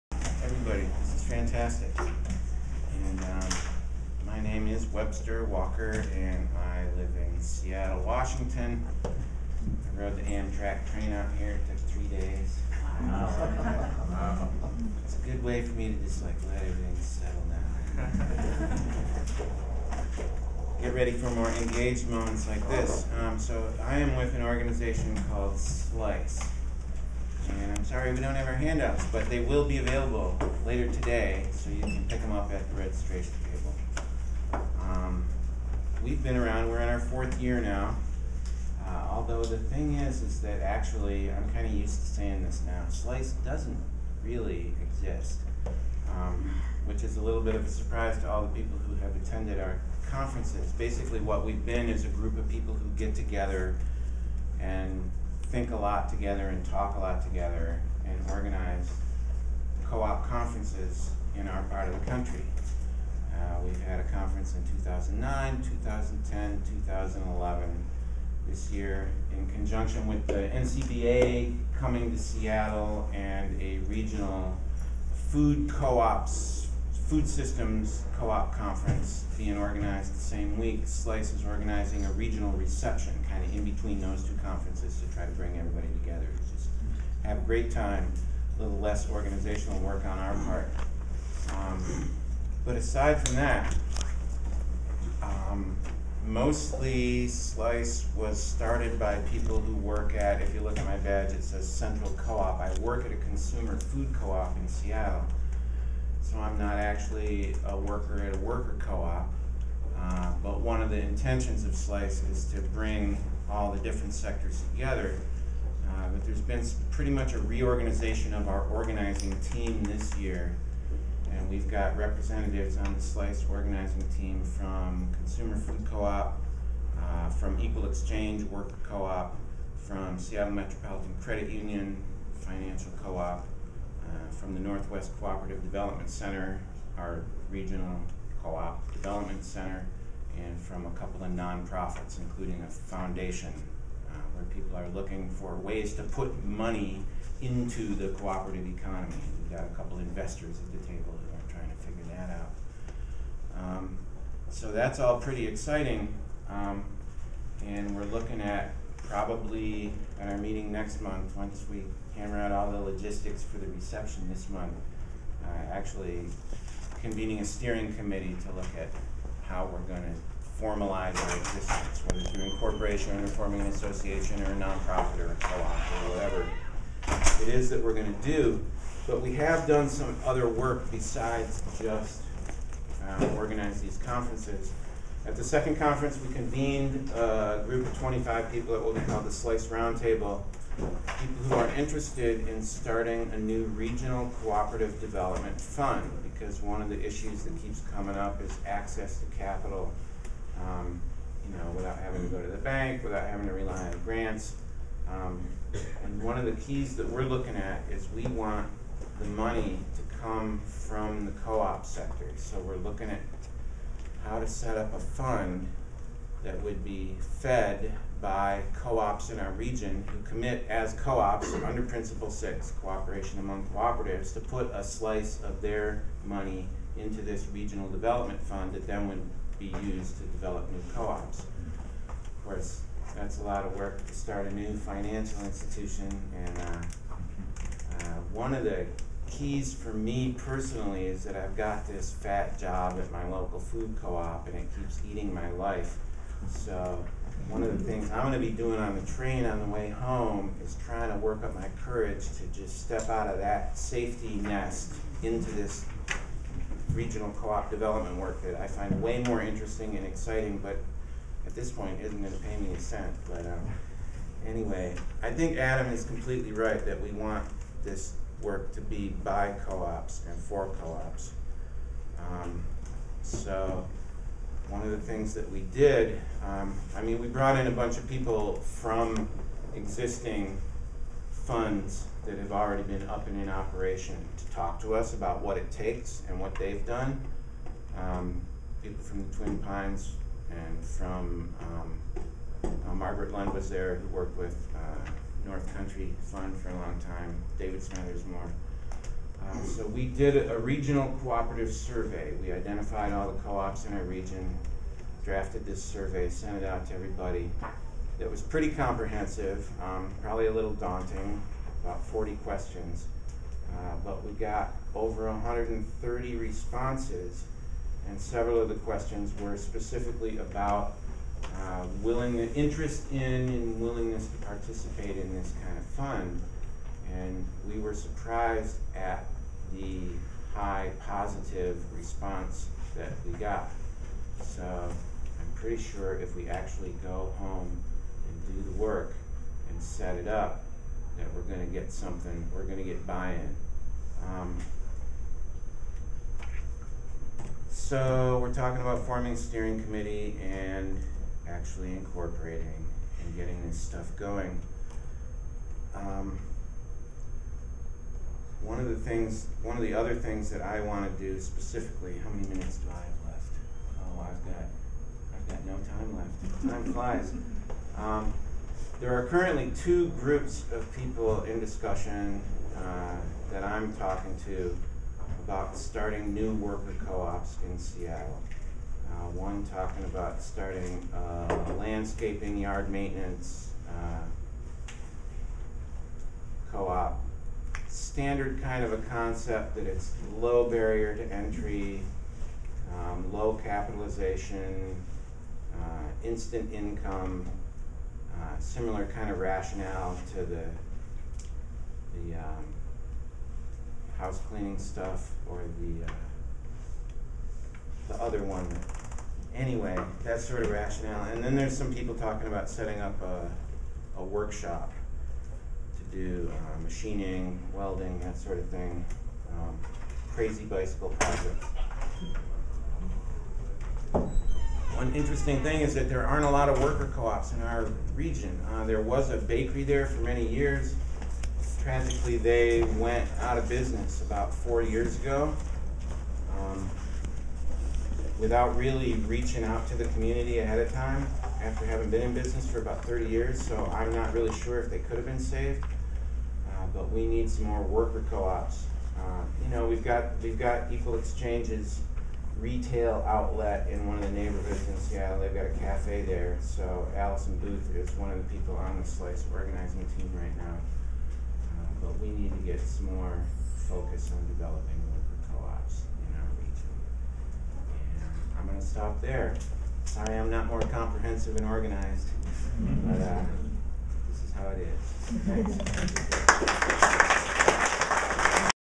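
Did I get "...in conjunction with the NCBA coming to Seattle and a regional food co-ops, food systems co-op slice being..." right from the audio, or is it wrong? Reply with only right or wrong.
wrong.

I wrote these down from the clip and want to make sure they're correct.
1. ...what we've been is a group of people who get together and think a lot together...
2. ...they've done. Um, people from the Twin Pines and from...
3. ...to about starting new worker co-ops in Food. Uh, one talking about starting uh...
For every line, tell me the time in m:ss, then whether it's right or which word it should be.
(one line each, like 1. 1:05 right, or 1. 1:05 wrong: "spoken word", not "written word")
1. 0:51 right
2. 4:46 right
3. 6:14 wrong: "Seattle", not "Food".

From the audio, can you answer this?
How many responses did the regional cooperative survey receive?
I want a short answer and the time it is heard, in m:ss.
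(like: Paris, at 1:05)
over 130, at 5:14.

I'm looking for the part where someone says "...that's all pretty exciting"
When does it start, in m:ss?
2:34.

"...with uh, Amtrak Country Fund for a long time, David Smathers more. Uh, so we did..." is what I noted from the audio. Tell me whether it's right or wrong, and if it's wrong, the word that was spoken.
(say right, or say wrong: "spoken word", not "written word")
wrong: "North", not "Amtrak".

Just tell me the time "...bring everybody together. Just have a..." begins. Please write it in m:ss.
1:25.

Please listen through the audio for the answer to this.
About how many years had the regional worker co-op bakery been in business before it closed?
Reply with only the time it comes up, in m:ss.
7:23.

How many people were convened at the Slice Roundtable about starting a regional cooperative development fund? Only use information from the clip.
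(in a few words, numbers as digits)
25.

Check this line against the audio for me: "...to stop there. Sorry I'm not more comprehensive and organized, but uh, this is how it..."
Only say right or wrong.
right.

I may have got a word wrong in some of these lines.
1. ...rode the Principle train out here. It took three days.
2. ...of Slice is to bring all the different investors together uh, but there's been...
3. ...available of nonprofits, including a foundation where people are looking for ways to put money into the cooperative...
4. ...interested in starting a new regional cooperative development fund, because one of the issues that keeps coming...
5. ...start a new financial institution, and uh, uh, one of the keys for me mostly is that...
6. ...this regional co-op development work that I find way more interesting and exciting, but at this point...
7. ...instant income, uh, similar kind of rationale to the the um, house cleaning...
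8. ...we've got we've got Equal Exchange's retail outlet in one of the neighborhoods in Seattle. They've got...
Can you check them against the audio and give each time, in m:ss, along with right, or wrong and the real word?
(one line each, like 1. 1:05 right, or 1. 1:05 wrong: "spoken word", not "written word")
1. 0:09 wrong: "Amtrak", not "Principle"
2. 1:51 wrong: "sectors", not "investors"
3. 2:20 wrong: "couple", not "available"
4. 3:11 right
5. 3:54 wrong: "personally", not "mostly"
6. 4:15 right
7. 6:36 right
8. 7:29 right.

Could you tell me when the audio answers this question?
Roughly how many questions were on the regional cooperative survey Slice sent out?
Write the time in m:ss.
5:12.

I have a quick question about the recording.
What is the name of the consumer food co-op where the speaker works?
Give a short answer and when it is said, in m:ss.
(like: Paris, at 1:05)
Central Co-op, at 1:41.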